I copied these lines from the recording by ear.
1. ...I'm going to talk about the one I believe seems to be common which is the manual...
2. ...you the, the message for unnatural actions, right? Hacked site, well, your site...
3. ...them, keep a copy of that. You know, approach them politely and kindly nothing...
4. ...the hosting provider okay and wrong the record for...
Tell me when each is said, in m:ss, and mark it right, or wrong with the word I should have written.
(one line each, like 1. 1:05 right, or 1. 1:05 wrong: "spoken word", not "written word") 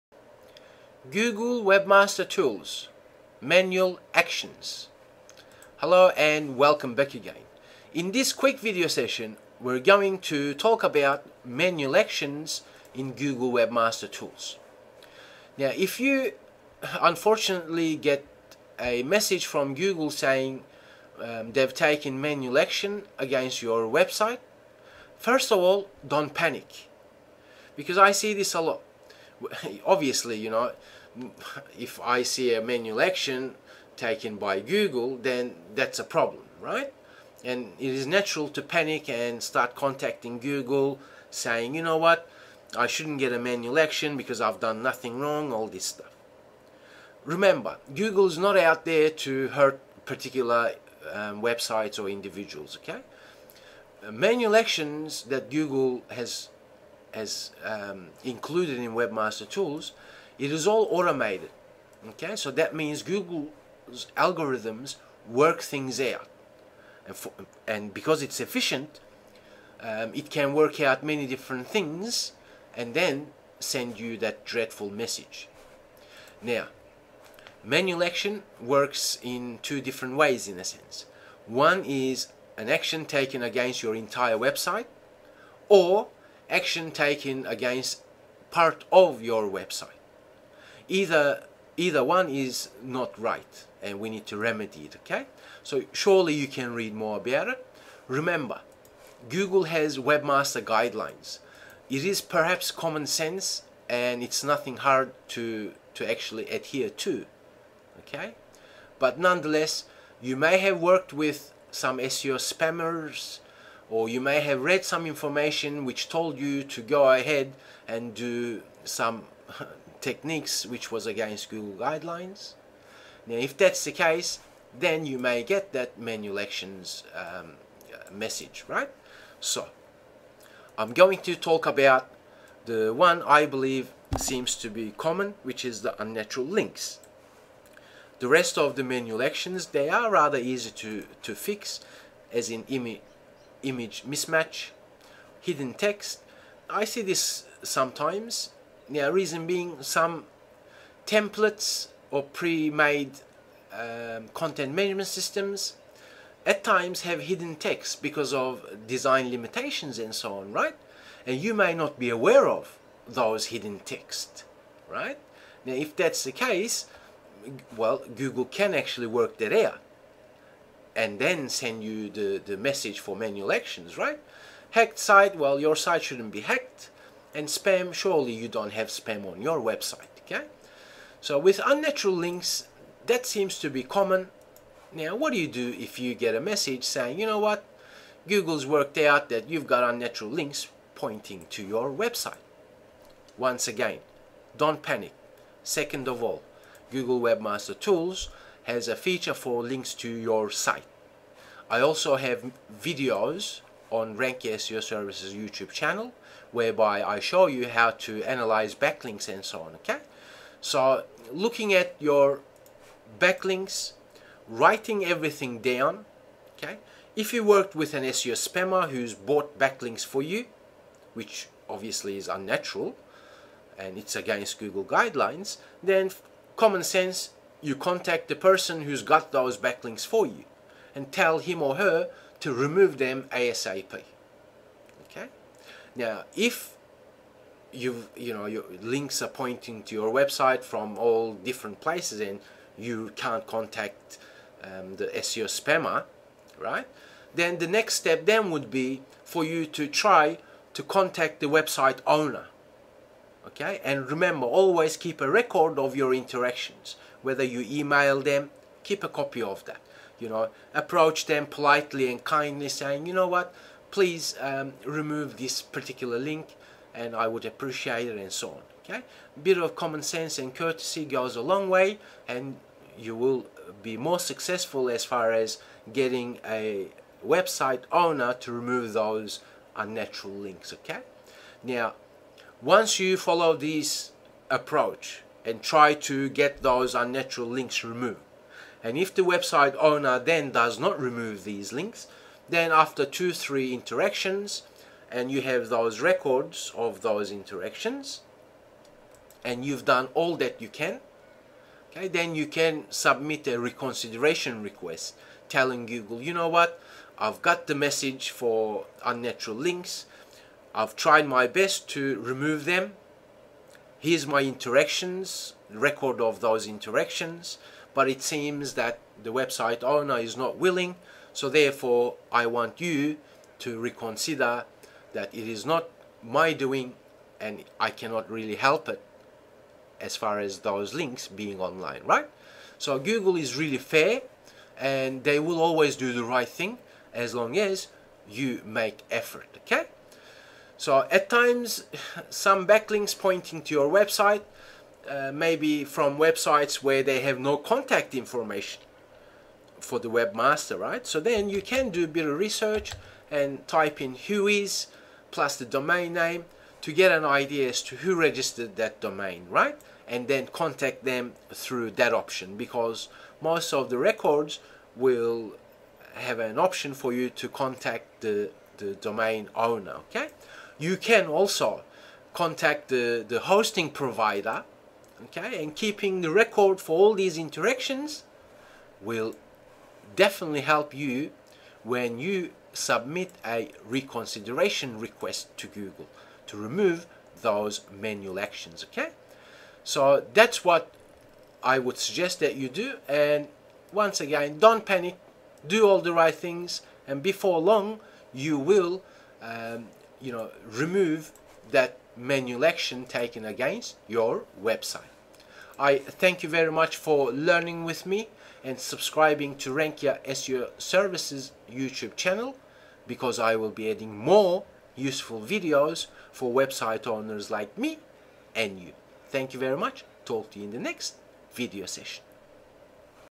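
1. 2:10 wrong: "unnatural", not "manual"
2. 2:51 wrong: "manual", not "unnatural"
3. 4:18 wrong: "saying", not "nothing"
4. 6:13 wrong: "keeping", not "wrong".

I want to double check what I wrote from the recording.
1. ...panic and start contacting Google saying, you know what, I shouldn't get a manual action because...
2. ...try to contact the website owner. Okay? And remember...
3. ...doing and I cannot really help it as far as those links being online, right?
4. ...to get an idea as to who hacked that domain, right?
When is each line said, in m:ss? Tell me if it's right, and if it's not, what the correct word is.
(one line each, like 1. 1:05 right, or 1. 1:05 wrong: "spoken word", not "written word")
1. 0:38 right
2. 4:09 right
3. 5:26 right
4. 5:56 wrong: "registered", not "hacked".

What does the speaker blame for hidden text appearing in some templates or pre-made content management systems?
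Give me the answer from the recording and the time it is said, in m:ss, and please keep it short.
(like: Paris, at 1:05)
Design limitations, at 2:38.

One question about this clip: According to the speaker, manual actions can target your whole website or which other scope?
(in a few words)
Part of your website.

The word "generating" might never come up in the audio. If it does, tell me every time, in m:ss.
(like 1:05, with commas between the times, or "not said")
not said.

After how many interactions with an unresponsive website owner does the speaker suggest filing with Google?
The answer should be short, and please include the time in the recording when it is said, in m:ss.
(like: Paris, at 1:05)
2 or 3, at 4:53.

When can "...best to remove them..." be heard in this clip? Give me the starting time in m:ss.
5:11.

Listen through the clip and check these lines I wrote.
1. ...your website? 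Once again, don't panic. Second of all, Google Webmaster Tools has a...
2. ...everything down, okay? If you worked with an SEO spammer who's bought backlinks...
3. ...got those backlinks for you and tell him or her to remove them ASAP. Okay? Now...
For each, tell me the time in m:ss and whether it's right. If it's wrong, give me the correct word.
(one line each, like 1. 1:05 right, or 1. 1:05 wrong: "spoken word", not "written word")
1. 3:11 right
2. 3:35 right
3. 3:49 right.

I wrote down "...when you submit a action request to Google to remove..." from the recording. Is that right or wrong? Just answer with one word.
wrong.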